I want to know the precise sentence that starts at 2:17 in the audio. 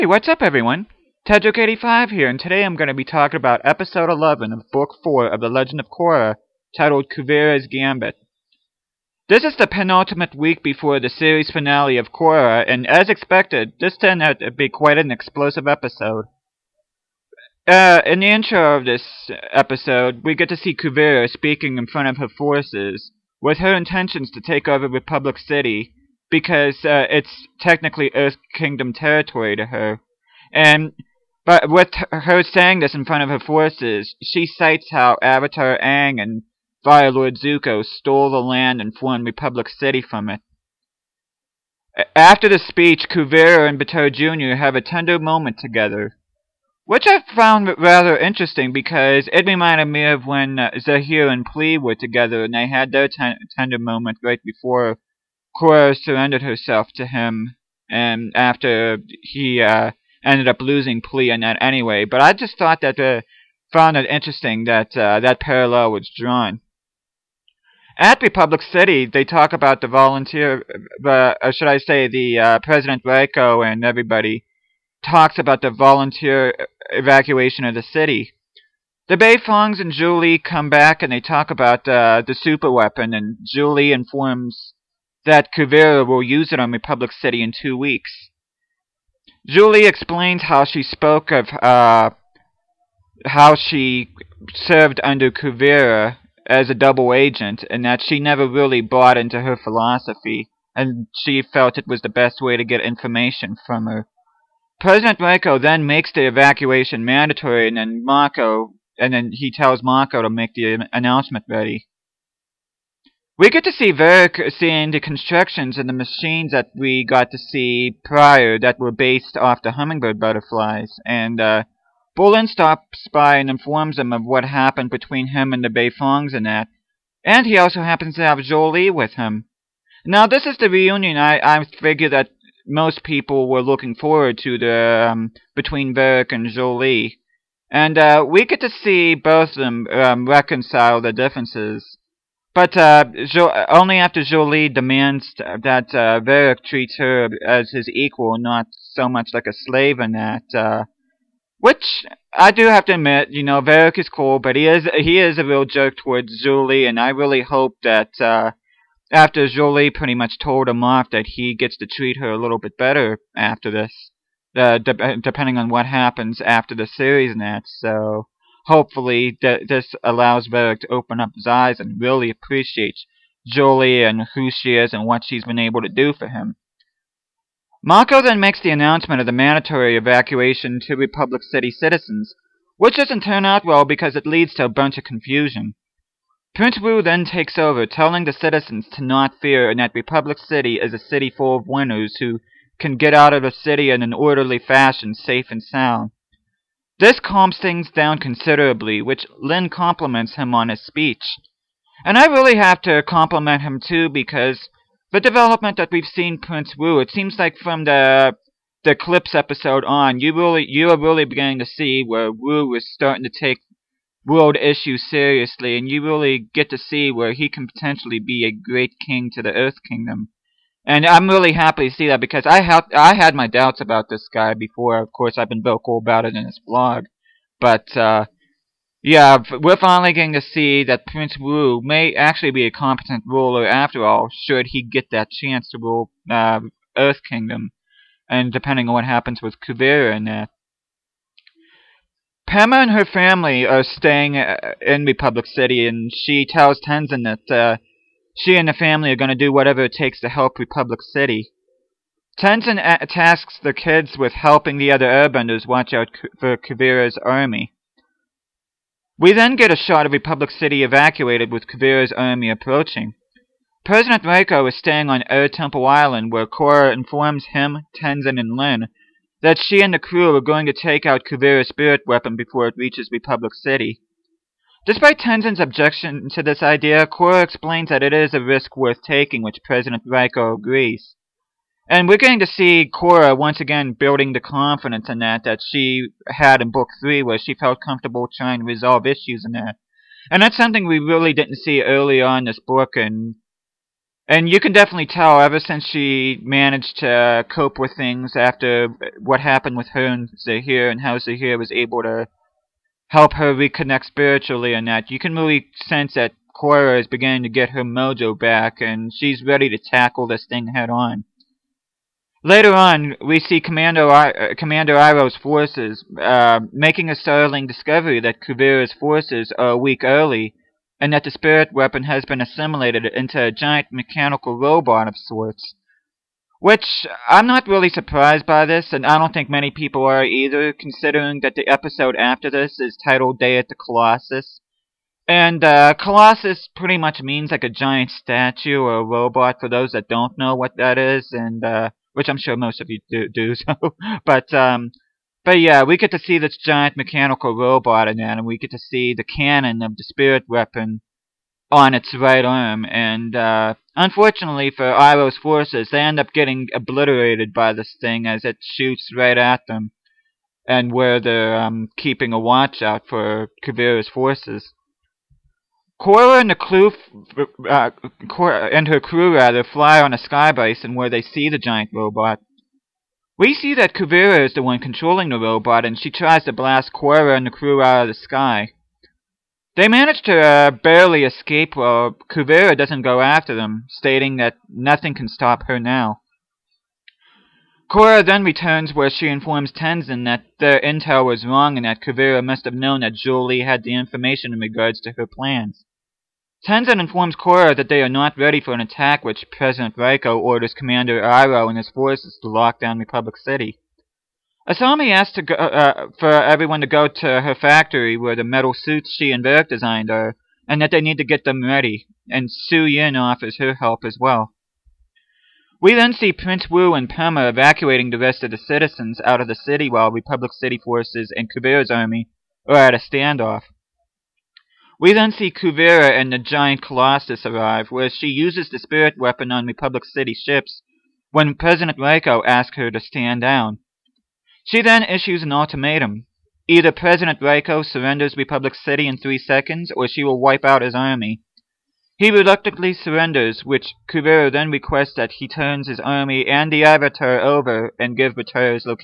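And uh, we get to see both of them um, reconcile their differences.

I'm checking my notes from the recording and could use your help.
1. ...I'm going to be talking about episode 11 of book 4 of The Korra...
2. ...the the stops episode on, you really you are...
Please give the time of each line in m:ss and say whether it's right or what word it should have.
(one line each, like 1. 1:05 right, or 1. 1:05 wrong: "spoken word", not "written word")
1. 0:02 wrong: "Legend", not "Korra"
2. 3:27 wrong: "clips", not "stops".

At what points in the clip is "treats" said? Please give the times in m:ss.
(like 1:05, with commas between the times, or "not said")
2:26, 2:41.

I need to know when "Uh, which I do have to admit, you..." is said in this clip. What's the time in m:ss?
2:30.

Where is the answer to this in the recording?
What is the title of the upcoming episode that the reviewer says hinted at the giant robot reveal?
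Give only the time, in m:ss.
5:33.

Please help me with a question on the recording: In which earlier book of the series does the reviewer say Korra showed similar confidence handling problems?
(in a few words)
Book 3.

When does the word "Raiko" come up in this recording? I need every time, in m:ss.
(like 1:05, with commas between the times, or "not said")
1:13, 1:45, 4:24, 4:40, 6:39, 7:12, 7:17.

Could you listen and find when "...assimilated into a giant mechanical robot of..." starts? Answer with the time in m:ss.
5:22.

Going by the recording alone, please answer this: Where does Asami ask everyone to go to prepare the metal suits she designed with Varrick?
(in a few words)
Her factory.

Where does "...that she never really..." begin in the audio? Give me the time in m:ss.
1:37.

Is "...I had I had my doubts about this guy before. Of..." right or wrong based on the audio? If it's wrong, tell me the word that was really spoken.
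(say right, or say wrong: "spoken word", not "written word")
right.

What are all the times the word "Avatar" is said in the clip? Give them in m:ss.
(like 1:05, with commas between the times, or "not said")
0:35, 7:26.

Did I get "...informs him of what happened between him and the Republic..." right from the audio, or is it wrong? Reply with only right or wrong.
wrong.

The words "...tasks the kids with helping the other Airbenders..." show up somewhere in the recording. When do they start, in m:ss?
4:13.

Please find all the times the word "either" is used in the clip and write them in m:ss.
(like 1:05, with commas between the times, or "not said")
5:30, 7:16.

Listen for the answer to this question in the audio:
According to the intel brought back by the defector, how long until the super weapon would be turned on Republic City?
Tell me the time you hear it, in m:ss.
1:27.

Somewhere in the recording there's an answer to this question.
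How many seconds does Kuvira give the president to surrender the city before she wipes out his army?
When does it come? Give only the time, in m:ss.
7:19.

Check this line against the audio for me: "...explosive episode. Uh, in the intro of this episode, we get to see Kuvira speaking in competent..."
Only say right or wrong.
wrong.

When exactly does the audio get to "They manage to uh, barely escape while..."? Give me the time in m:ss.
6:19.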